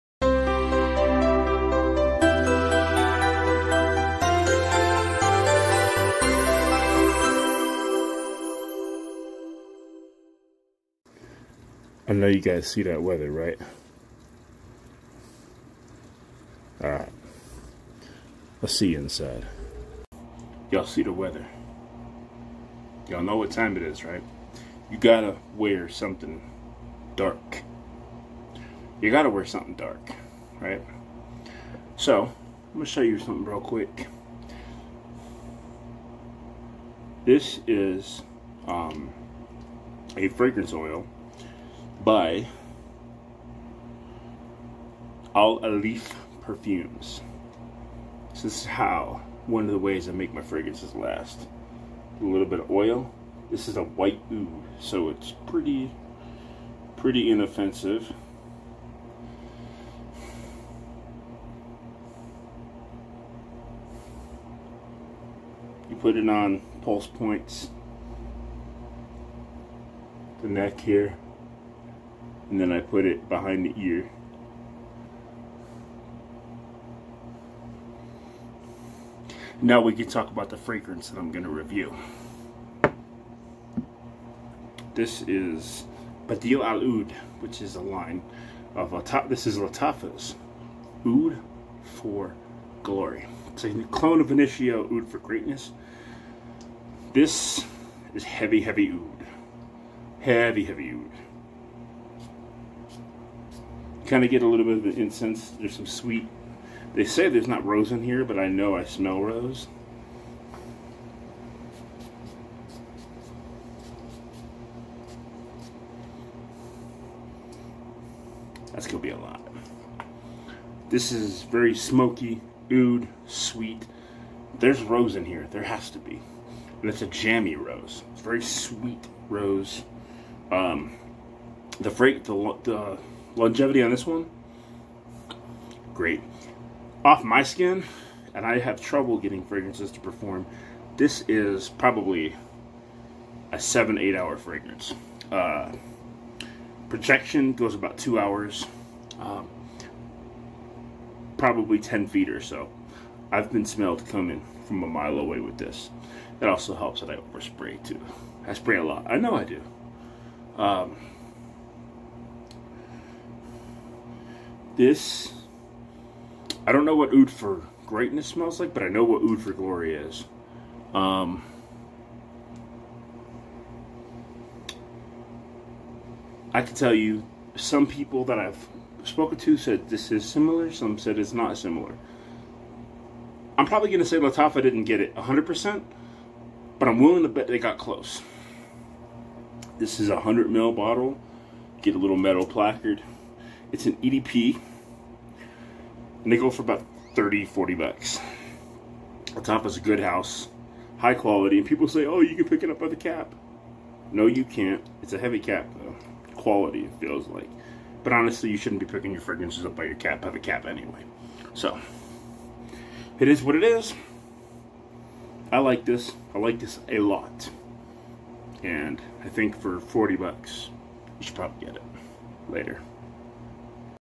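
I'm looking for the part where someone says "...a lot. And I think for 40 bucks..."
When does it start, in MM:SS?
03:36.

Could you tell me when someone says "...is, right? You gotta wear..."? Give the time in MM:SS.
00:23.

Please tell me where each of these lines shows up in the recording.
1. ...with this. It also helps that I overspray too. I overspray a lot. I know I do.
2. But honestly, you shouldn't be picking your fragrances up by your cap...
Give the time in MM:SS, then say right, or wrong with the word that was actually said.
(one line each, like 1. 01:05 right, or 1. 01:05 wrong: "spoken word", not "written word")
1. 02:35 wrong: "spray", not "overspray"
2. 03:28 right.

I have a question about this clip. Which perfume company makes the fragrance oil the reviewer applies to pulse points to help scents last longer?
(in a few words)
Al Alif Perfumes.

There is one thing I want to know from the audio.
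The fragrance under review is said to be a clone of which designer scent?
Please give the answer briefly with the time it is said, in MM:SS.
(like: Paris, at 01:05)
Initio Oud for Greatness, at 01:34.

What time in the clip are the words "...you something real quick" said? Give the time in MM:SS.
00:33.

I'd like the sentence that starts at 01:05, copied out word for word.
You put it on pulse points, the neck here, and then I put it behind the ear.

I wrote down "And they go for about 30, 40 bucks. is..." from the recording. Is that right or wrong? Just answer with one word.
right.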